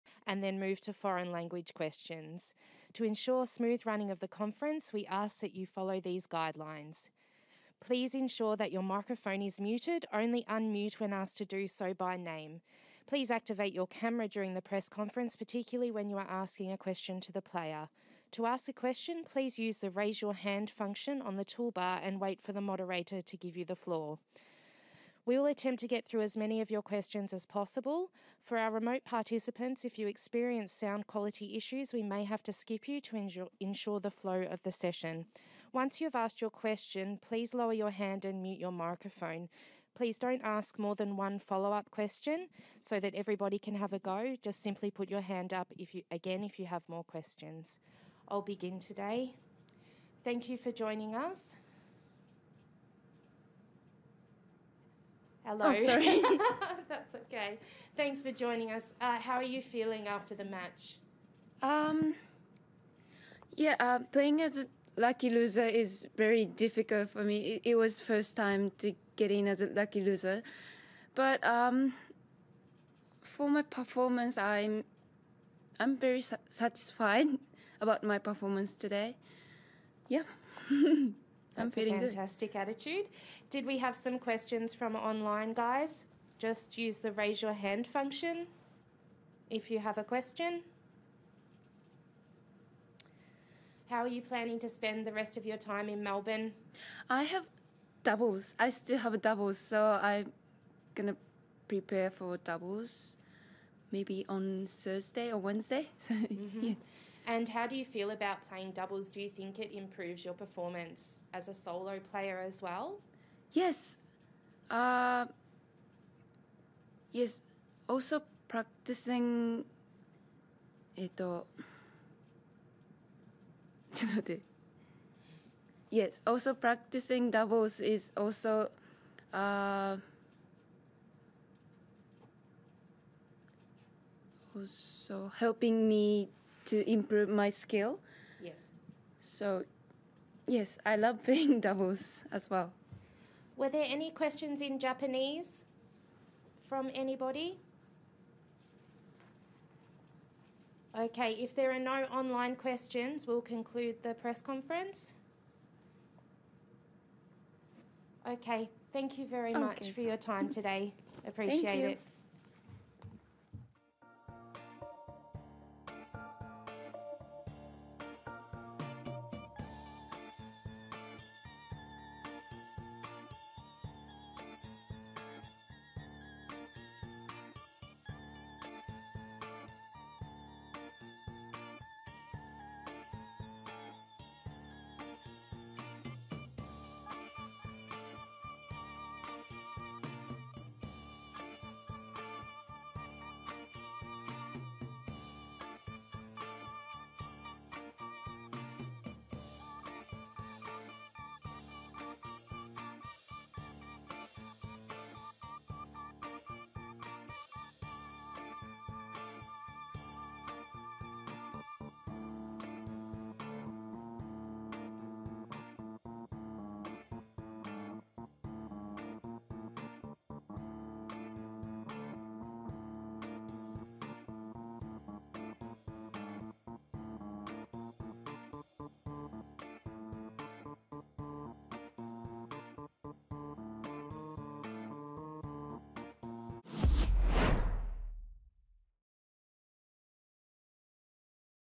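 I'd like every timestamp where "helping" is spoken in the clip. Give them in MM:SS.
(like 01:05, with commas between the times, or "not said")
02:15.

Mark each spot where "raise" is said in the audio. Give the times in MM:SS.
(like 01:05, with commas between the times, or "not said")
00:19, 01:27.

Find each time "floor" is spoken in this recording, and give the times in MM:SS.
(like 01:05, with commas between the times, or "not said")
00:23.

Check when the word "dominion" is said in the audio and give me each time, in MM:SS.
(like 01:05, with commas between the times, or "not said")
not said.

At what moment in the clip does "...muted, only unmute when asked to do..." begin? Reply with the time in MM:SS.
00:09.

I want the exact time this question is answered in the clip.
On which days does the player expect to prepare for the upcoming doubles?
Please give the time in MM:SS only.
01:44.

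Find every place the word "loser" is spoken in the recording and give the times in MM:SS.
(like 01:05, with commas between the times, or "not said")
01:05, 01:09.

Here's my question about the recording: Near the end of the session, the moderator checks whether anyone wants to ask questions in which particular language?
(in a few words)
Japanese.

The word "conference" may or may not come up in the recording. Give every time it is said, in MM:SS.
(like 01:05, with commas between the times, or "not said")
00:04, 00:14, 02:34.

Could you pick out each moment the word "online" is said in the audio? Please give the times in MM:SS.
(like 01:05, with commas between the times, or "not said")
01:24, 02:32.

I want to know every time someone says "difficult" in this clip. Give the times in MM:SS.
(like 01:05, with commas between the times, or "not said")
01:06.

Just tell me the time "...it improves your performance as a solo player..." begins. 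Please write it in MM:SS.
01:49.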